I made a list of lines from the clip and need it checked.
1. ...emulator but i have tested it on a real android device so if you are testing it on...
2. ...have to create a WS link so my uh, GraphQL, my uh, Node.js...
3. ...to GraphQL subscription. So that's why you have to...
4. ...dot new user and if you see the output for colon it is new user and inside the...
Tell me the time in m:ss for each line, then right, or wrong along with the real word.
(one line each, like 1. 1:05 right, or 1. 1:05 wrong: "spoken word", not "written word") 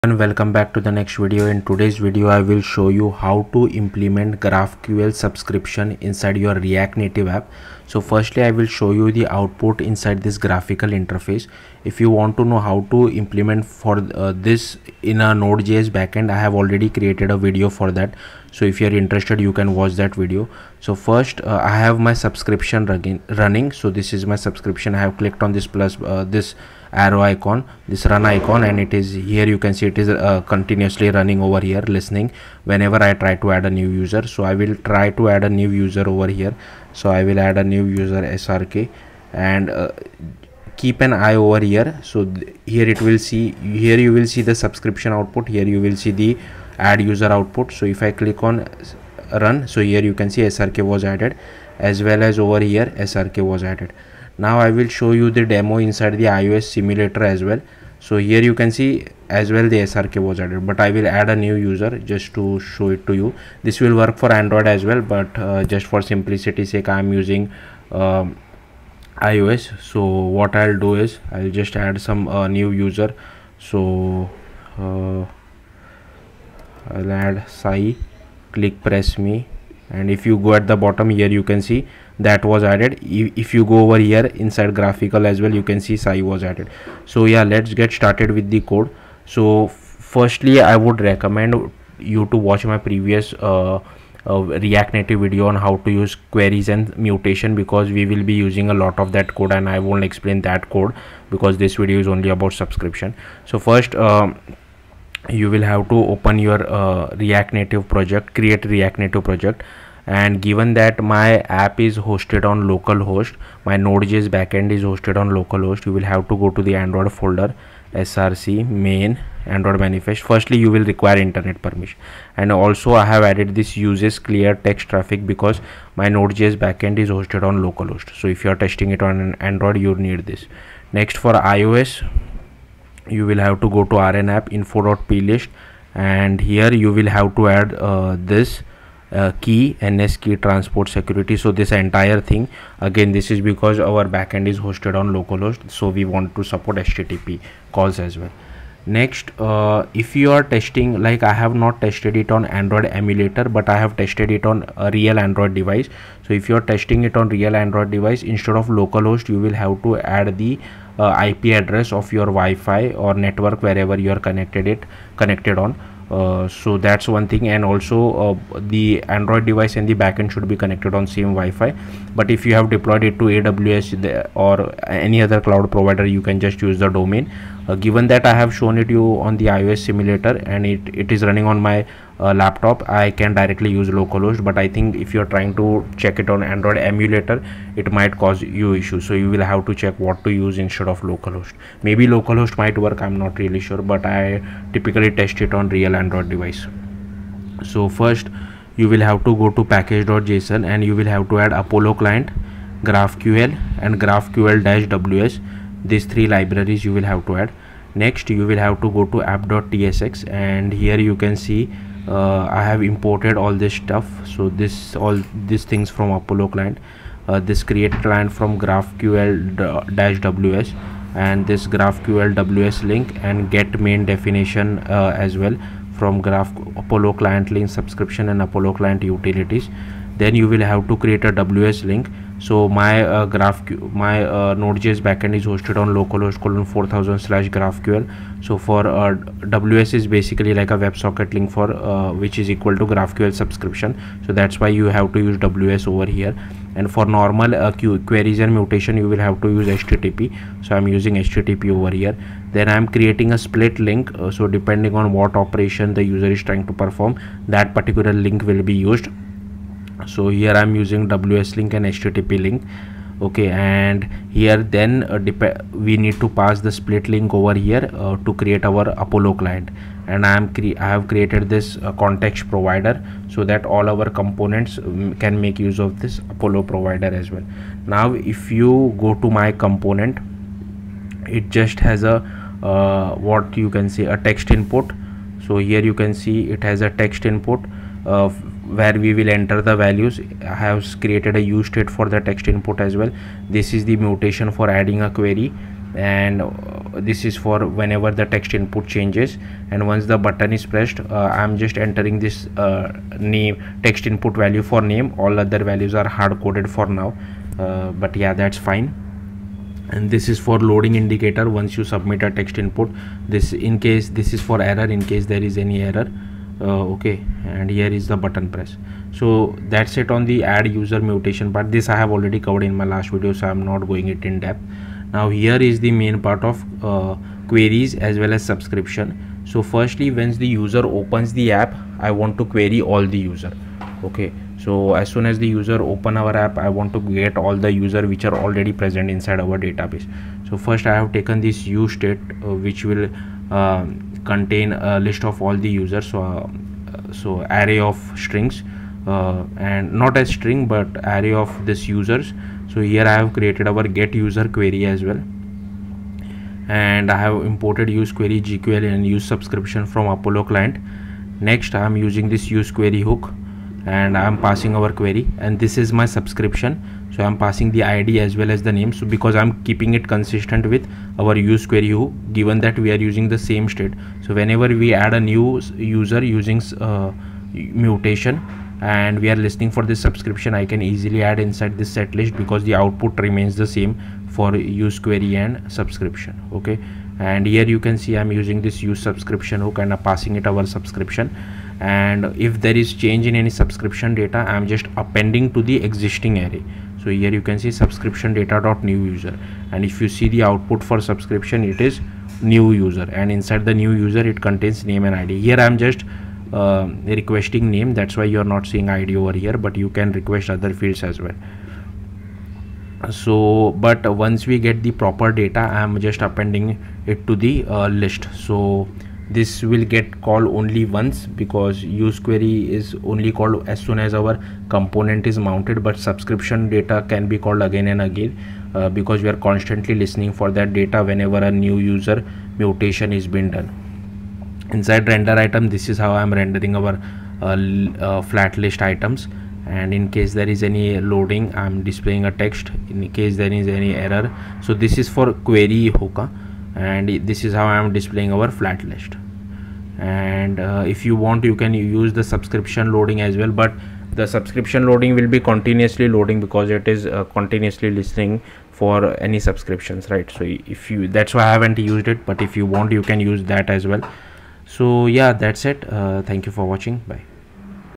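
1. 2:32 right
2. 3:50 right
3. 4:02 right
4. 6:38 wrong: "subscription", not "colon".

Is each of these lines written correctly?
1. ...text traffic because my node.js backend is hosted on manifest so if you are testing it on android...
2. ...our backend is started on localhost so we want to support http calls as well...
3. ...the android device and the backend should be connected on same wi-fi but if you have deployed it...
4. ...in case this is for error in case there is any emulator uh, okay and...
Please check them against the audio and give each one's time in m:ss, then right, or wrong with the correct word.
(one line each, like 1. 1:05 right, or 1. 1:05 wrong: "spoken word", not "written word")
1. 2:04 wrong: "localhost", not "manifest"
2. 2:23 wrong: "hosted", not "started"
3. 2:48 right
4. 5:13 wrong: "error", not "emulator".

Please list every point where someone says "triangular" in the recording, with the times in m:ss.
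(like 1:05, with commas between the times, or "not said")
not said.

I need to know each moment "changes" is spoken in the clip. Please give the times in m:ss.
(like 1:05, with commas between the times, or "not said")
4:58, 6:32.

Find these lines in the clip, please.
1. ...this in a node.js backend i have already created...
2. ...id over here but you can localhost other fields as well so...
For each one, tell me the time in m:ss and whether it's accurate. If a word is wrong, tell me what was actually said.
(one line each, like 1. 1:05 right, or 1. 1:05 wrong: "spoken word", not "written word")
1. 0:14 right
2. 6:48 wrong: "request", not "localhost".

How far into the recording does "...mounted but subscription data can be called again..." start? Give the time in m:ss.
7:05.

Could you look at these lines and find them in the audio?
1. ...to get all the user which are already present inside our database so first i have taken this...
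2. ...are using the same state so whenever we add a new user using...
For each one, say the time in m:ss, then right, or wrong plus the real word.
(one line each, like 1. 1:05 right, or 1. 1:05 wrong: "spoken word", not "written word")
1. 5:36 right
2. 6:12 right.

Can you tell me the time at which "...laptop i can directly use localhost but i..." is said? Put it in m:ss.
3:02.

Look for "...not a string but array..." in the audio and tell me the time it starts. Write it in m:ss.
5:49.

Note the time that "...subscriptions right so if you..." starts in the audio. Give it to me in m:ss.
7:39.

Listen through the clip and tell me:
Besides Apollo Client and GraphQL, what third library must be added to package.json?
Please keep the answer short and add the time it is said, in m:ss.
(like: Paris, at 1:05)
graphql-ws, at 3:24.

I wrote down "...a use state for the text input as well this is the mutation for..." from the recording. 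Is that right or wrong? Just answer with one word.
right.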